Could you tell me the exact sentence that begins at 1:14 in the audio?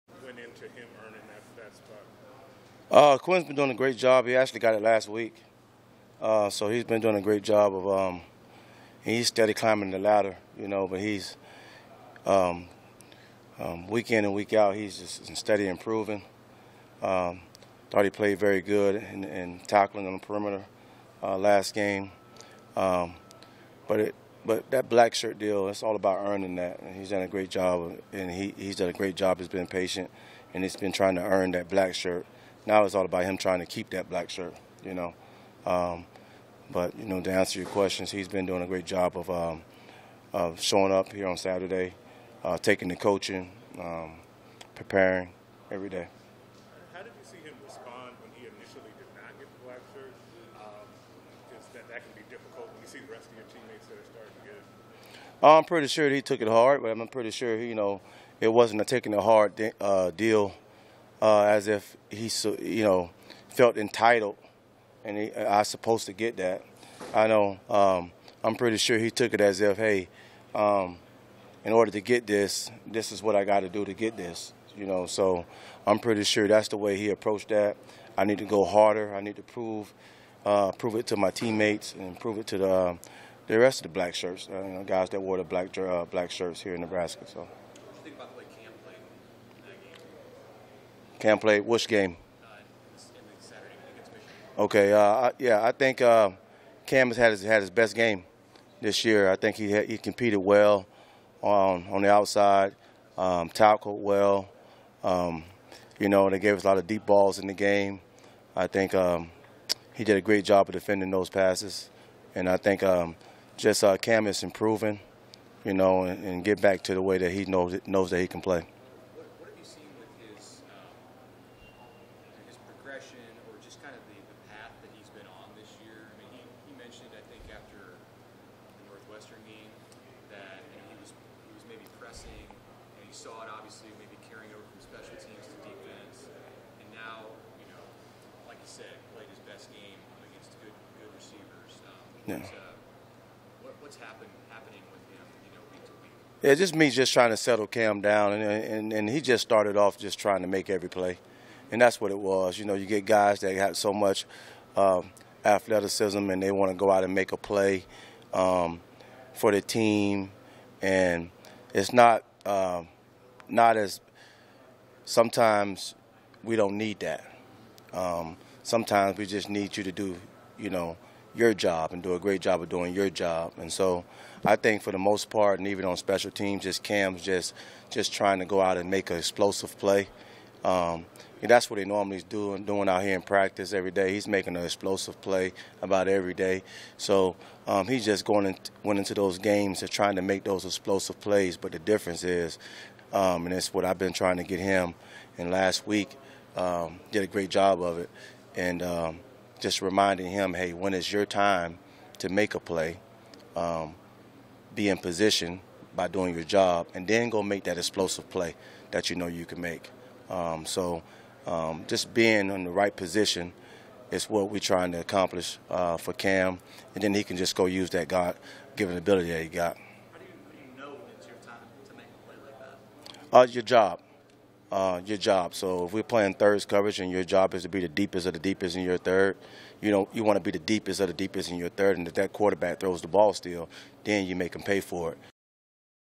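You know, so I'm pretty sure that's the way he approached that.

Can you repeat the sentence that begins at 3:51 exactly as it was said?
And if that quarterback throws the ball still, then you make him pay for it.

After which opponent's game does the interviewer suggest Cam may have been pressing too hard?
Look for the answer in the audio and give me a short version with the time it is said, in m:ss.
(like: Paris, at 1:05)
Northwestern, at 2:08.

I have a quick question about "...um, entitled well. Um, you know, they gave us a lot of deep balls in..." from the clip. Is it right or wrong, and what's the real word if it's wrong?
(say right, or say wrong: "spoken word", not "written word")
wrong: "tackled", not "entitled".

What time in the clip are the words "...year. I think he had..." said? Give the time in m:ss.
1:39.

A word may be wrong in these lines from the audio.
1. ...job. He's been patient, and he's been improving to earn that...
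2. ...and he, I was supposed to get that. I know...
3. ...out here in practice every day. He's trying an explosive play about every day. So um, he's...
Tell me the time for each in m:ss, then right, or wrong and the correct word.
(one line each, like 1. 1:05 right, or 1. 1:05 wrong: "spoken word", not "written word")
1. 0:29 wrong: "trying", not "improving"
2. 1:05 right
3. 3:02 wrong: "making", not "trying".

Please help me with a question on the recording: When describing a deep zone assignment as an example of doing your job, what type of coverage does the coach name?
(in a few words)
thirds coverage.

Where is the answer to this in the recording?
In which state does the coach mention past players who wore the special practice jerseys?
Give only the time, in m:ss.
1:26.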